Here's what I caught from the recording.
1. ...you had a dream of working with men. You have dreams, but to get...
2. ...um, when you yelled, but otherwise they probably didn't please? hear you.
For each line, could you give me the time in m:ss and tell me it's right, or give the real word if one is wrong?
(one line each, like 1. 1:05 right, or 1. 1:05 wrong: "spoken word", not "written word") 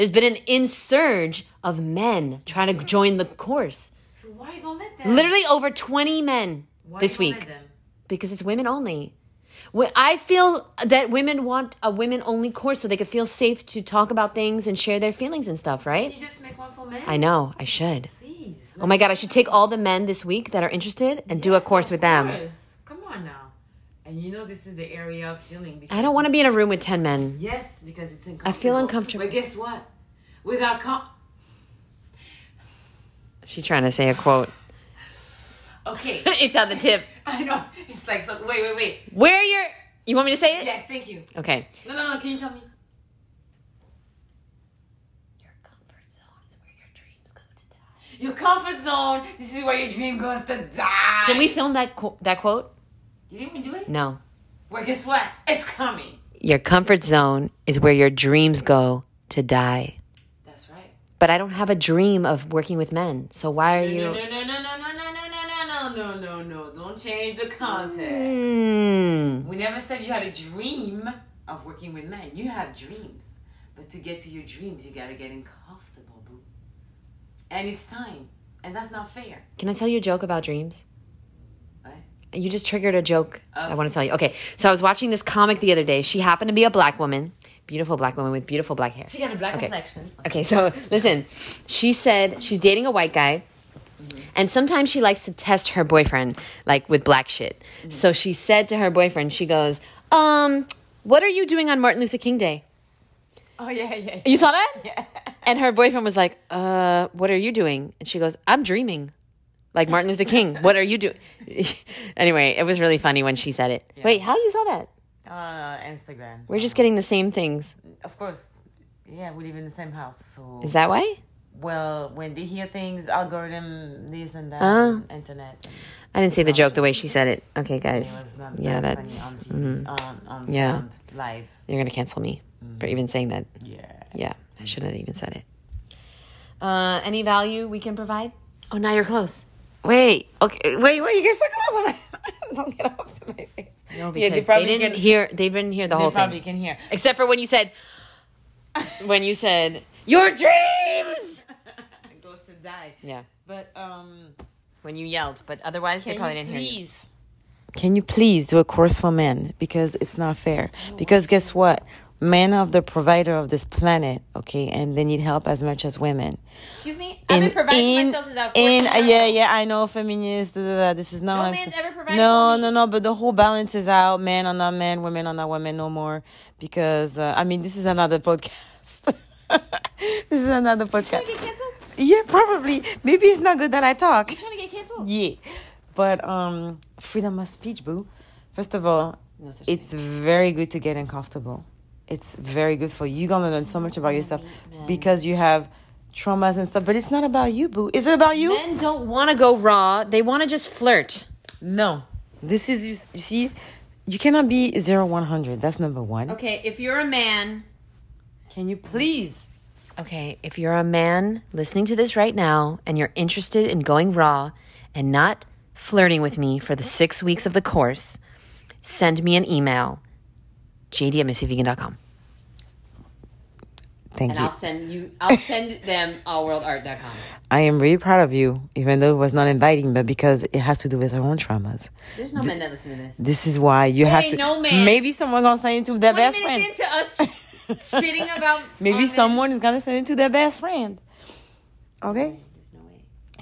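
1. 1:10 right
2. 2:33 right.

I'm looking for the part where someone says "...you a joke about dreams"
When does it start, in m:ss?
1:19.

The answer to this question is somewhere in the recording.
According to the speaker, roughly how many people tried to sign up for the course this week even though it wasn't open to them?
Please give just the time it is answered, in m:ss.
0:05.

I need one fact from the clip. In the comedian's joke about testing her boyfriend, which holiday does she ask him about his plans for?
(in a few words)
Martin Luther King Day.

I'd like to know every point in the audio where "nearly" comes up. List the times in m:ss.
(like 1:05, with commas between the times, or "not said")
not said.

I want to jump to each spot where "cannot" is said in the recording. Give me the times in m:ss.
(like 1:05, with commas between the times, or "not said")
3:24.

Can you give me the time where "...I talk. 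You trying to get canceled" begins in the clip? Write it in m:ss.
3:03.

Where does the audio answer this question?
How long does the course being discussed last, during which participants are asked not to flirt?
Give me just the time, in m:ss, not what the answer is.
3:36.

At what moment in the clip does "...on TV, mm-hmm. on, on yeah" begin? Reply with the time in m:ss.
2:09.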